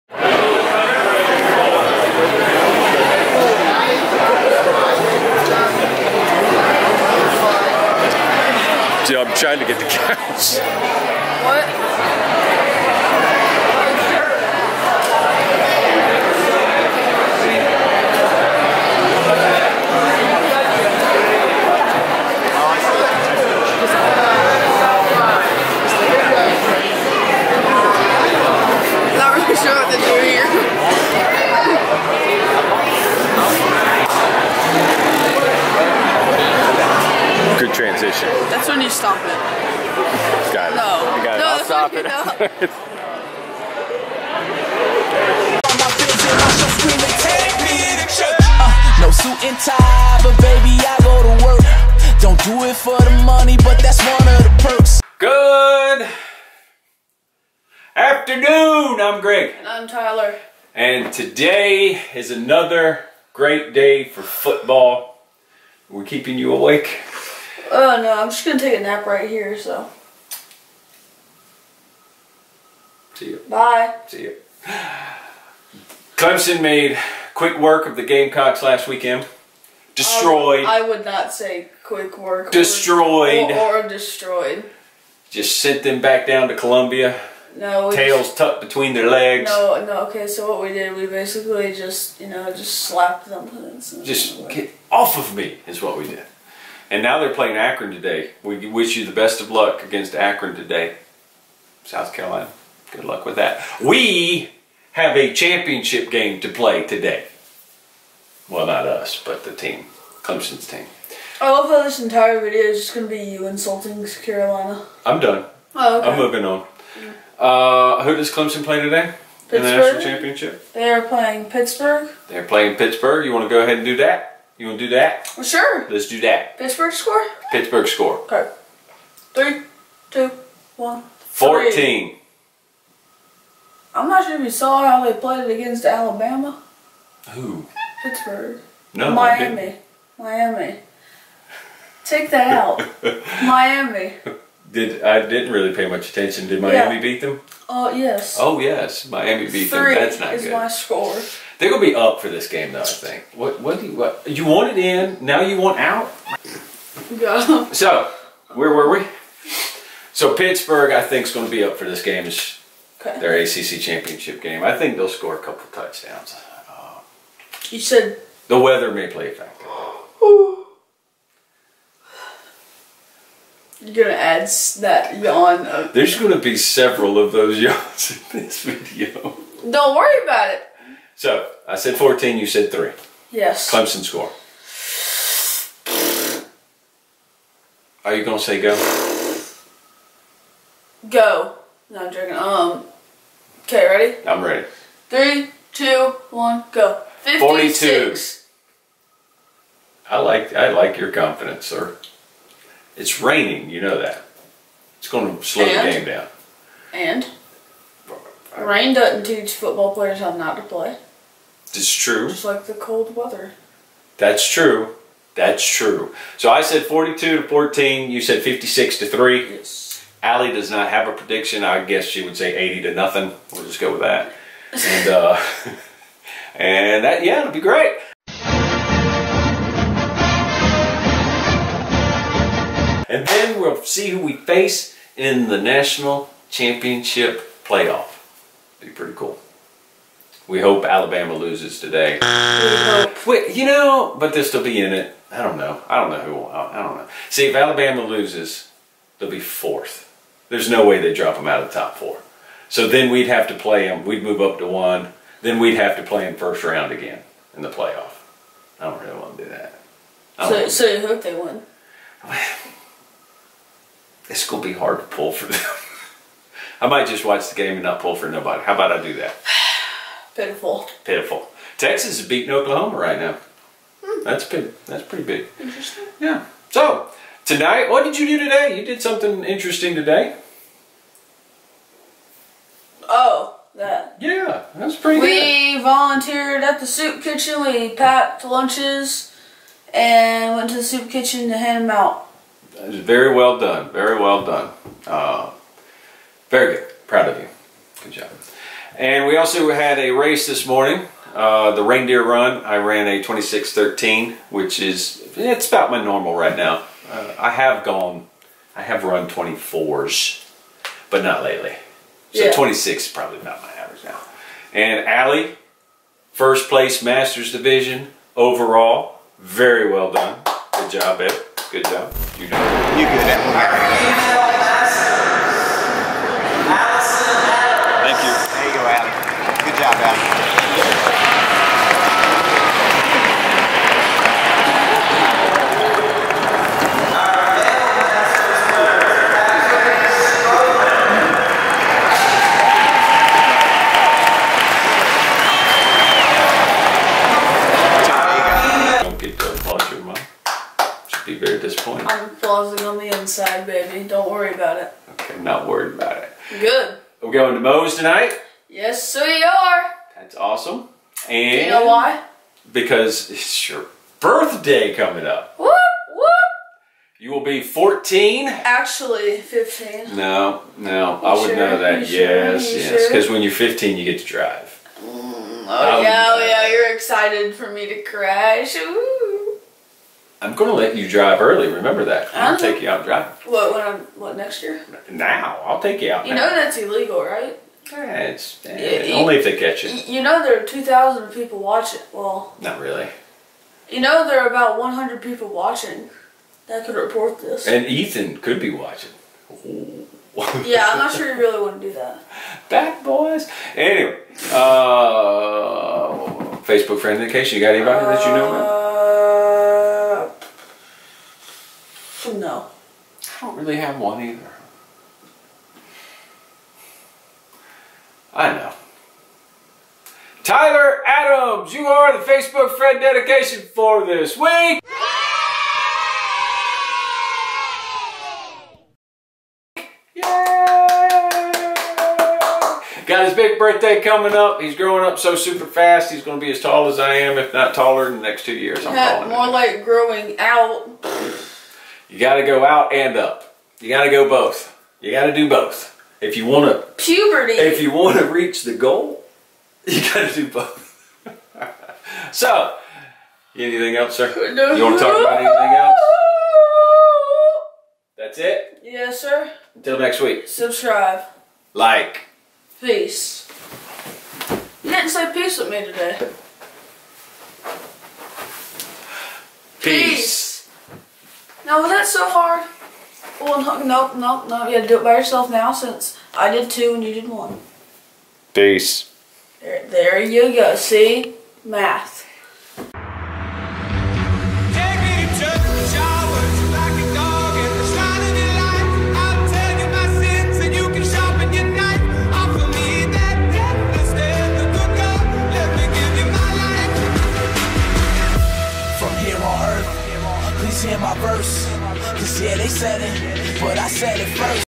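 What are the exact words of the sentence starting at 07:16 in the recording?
He's going to be as tall as I am, if not taller, in the next two years.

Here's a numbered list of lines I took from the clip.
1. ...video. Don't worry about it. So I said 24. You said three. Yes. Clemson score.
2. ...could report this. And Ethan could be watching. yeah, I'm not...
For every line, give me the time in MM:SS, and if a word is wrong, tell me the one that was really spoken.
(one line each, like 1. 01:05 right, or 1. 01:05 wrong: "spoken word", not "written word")
1. 02:58 wrong: "14", not "24"
2. 06:36 right.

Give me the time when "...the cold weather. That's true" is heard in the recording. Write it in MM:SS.
03:32.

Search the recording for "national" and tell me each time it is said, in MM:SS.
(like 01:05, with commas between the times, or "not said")
01:59, 03:55.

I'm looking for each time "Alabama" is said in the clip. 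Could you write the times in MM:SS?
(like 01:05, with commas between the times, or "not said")
02:15, 04:00, 04:07.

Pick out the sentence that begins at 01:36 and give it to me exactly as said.
And now they're playing Akron today.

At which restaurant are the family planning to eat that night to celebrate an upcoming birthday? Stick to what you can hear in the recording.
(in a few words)
Moe's.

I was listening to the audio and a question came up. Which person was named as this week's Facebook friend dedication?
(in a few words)
Tyler Adams.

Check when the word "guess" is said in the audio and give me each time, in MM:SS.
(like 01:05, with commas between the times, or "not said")
03:41.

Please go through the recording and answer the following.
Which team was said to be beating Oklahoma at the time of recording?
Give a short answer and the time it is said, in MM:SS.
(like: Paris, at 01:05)
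Texas, at 04:31.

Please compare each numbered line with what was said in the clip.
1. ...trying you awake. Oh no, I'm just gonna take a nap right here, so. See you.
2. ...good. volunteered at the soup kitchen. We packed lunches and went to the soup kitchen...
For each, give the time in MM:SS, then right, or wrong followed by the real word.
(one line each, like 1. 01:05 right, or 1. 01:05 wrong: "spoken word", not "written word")
1. 01:06 wrong: "keeping", not "trying"
2. 04:45 right.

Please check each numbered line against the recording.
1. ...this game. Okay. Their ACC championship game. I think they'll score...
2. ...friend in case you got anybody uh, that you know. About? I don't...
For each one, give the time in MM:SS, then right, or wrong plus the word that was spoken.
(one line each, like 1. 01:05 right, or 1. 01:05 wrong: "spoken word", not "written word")
1. 02:41 right
2. 06:47 right.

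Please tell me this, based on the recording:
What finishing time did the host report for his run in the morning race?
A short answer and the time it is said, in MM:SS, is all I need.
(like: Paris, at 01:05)
26.13, at 05:03.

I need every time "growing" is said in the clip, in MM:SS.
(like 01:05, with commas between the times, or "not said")
07:14, 07:19.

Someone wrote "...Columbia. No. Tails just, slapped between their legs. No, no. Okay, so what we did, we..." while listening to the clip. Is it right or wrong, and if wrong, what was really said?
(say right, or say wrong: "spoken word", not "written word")
wrong: "tucked", not "slapped".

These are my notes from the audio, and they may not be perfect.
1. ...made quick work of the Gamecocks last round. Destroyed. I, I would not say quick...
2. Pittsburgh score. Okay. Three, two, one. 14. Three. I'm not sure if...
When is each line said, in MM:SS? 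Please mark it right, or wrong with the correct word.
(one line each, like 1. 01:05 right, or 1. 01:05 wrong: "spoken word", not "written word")
1. 01:16 wrong: "weekend", not "round"
2. 02:07 right.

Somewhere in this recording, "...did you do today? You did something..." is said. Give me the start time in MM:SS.
04:38.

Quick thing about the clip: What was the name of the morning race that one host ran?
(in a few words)
reindeer run.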